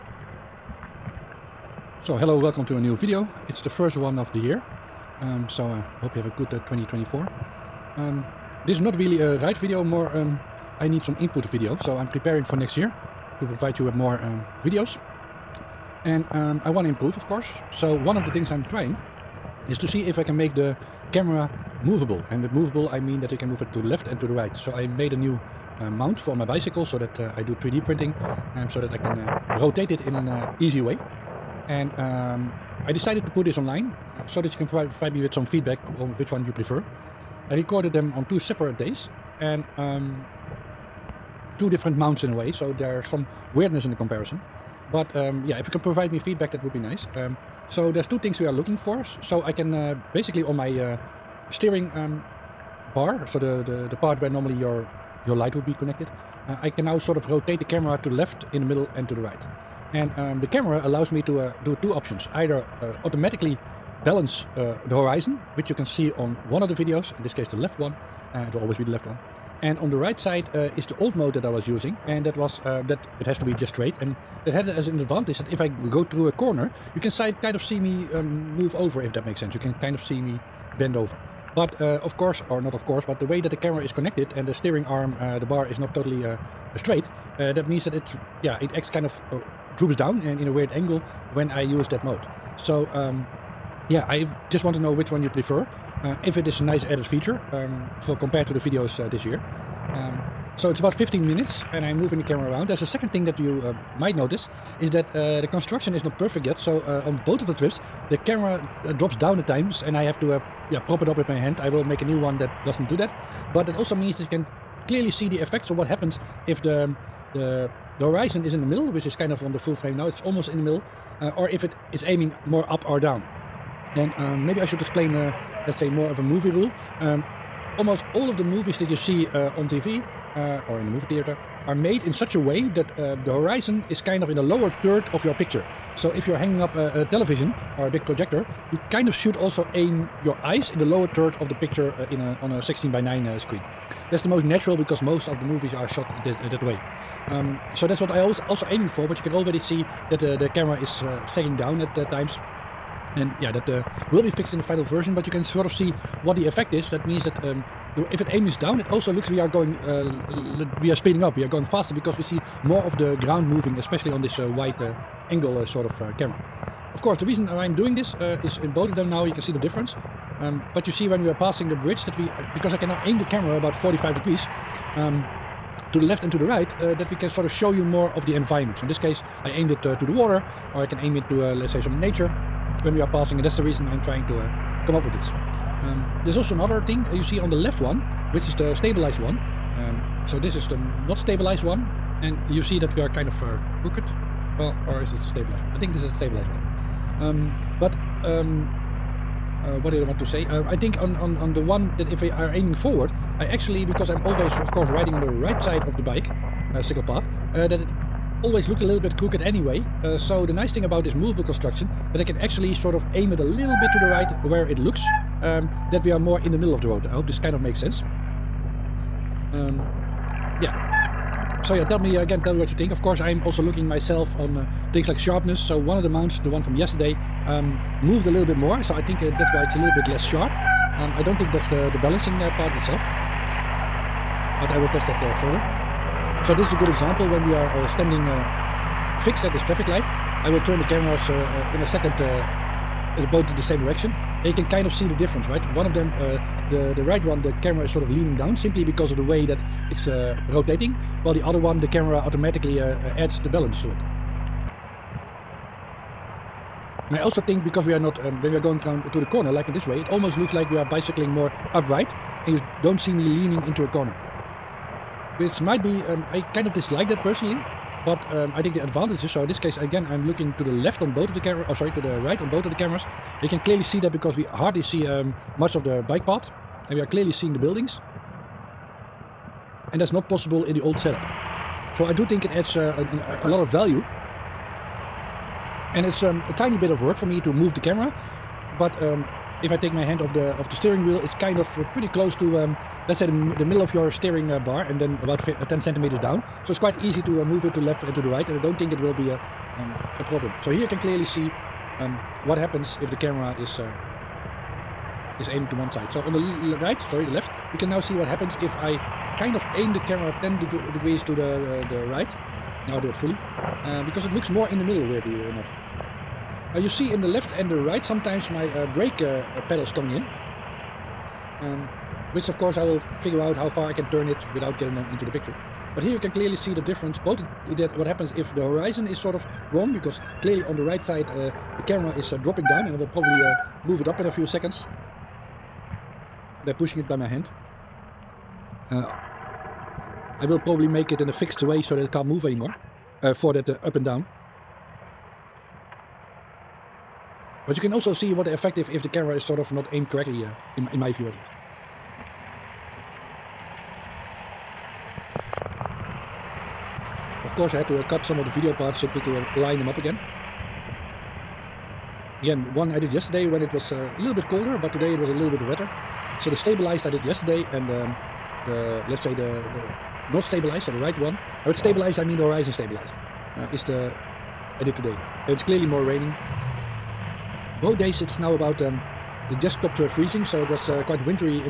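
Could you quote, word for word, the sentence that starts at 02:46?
Of course, the reason I'm doing this uh, is in both of them now you can see the difference.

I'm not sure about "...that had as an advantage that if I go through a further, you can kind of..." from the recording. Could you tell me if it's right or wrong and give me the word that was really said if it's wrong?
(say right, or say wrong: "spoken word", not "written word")
wrong: "corner", not "further".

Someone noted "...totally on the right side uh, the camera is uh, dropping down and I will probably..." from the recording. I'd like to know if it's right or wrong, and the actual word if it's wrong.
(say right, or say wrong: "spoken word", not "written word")
wrong: "clearly", not "totally".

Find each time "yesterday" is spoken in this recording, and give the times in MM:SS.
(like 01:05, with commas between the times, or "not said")
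03:46, 06:03, 06:07.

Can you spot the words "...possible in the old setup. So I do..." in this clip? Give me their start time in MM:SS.
04:40.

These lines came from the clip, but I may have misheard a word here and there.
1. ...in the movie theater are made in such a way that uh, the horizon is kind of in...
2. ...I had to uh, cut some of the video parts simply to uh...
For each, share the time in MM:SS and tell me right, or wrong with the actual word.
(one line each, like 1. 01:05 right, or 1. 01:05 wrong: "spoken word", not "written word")
1. 02:10 right
2. 05:57 right.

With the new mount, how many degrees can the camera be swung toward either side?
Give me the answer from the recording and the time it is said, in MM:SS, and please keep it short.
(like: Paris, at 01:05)
45 degrees, at 02:53.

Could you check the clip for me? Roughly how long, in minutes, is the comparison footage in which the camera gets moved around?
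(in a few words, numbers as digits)
15 minutes.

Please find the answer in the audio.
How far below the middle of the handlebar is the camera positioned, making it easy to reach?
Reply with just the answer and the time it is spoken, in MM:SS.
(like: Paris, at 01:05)
10 centimeters, at 04:55.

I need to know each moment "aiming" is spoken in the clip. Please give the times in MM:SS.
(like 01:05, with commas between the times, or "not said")
02:02, 02:28, 03:22, 05:05.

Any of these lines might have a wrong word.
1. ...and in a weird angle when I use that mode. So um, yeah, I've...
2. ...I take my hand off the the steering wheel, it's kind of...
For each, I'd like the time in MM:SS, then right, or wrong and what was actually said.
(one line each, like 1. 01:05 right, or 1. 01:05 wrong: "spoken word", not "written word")
1. 01:30 right
2. 04:49 right.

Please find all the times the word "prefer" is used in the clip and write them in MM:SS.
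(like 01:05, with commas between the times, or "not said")
00:36, 01:35.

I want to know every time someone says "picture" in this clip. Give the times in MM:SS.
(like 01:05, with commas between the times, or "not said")
02:15, 02:21, 05:25.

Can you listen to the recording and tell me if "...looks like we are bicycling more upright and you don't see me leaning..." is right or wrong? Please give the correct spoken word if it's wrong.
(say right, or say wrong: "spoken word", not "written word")
right.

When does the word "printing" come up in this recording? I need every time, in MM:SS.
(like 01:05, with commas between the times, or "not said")
00:27.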